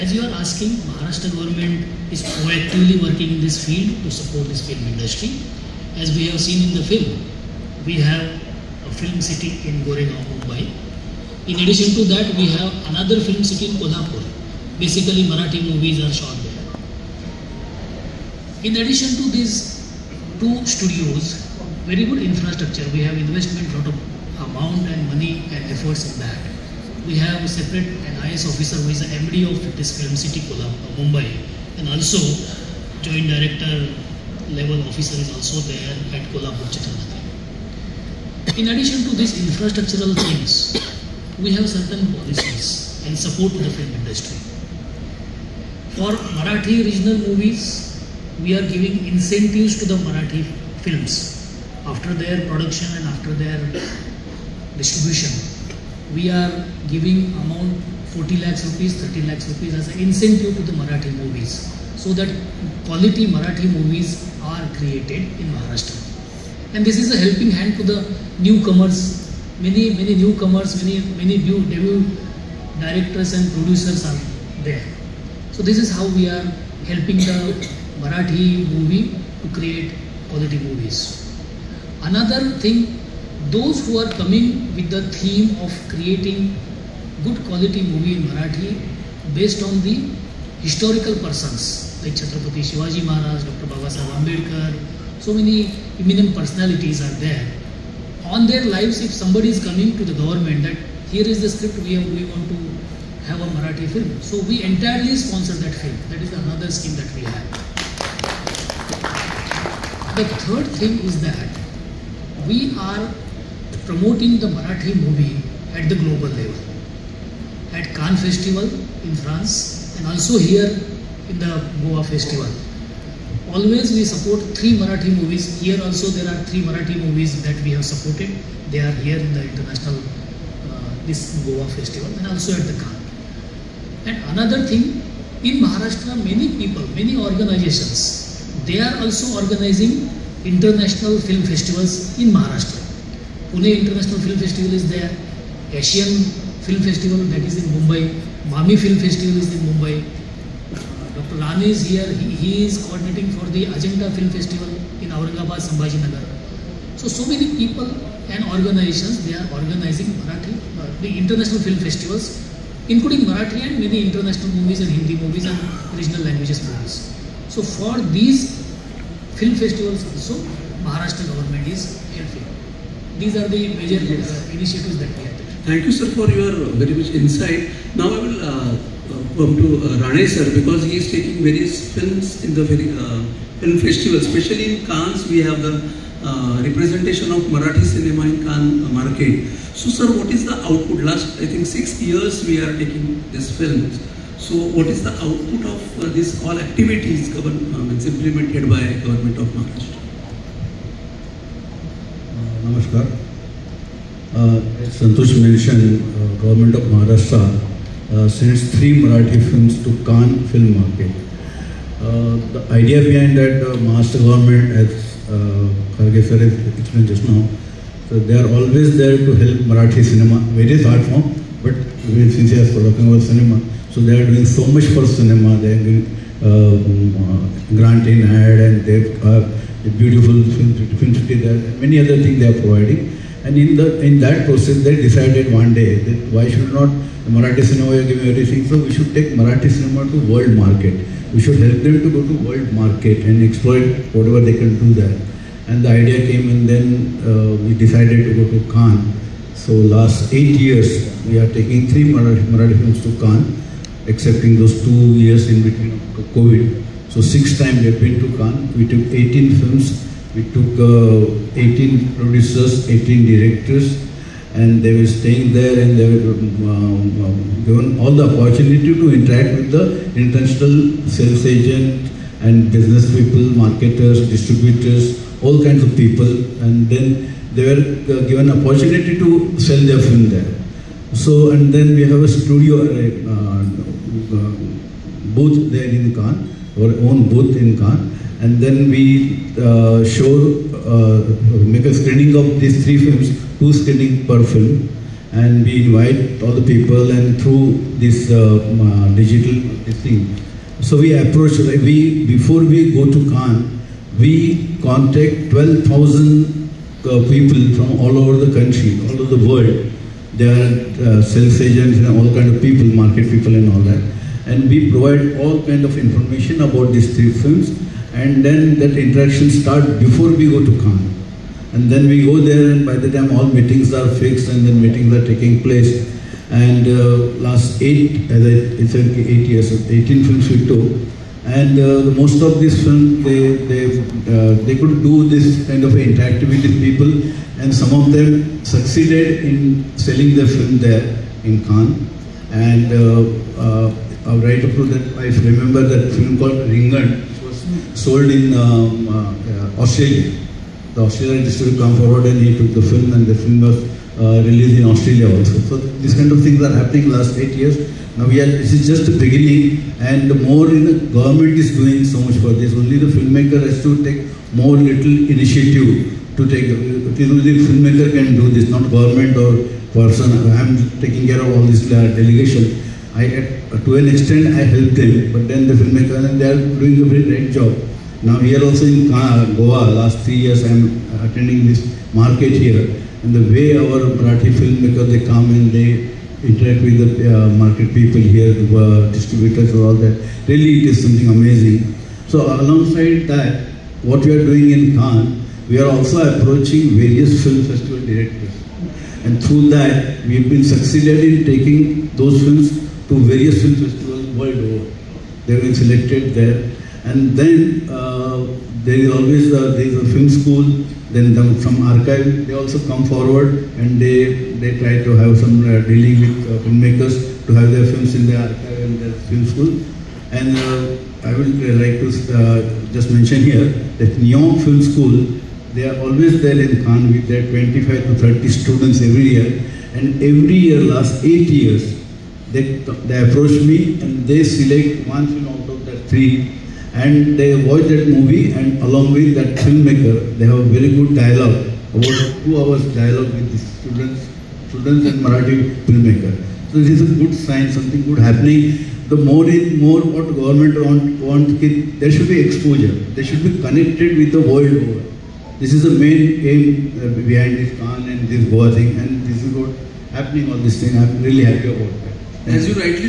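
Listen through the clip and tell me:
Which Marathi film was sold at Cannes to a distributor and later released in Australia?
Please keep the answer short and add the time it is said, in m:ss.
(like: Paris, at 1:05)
Ringan, at 5:46.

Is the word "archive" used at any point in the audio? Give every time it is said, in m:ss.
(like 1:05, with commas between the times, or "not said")
6:51, 6:58.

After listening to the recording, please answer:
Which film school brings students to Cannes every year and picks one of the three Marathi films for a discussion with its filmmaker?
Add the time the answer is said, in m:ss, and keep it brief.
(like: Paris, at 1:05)
Neon Film School, at 7:04.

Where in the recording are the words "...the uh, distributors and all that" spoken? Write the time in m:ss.
6:28.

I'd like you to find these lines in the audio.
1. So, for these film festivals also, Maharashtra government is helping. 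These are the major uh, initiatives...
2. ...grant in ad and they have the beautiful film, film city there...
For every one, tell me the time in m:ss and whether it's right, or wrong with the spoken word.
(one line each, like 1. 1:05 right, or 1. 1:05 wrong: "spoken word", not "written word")
1. 2:47 right
2. 3:47 right.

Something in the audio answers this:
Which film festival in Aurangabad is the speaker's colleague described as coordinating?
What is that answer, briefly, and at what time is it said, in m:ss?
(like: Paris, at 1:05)
Ajanta Film Festival, at 2:33.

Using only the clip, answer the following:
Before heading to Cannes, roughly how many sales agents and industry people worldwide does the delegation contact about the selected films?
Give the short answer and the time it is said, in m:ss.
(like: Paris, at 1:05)
12,000, at 5:05.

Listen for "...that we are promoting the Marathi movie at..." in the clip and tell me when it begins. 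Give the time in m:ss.
1:51.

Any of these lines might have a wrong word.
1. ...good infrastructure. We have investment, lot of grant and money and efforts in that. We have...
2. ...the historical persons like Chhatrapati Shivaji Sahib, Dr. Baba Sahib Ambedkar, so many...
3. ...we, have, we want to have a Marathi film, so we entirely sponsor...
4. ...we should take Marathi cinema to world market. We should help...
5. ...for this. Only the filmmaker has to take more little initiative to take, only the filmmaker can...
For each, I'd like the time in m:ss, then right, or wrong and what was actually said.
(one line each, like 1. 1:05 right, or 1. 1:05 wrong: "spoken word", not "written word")
1. 0:22 wrong: "amount", not "grant"
2. 1:29 wrong: "Maharaj", not "Sahib"
3. 1:41 right
4. 3:58 right
5. 6:02 right.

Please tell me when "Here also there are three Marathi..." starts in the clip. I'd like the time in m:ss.
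2:05.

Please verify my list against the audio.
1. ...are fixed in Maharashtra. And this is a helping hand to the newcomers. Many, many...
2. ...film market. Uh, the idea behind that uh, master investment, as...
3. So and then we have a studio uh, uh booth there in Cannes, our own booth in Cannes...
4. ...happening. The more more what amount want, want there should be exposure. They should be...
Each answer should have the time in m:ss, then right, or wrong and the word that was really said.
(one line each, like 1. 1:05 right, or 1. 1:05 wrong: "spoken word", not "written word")
1. 1:04 wrong: "created", not "fixed"
2. 3:30 wrong: "government", not "investment"
3. 4:41 right
4. 7:28 wrong: "government", not "amount".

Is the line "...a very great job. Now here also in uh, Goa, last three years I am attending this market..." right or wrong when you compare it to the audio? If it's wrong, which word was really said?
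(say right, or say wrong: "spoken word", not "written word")
right.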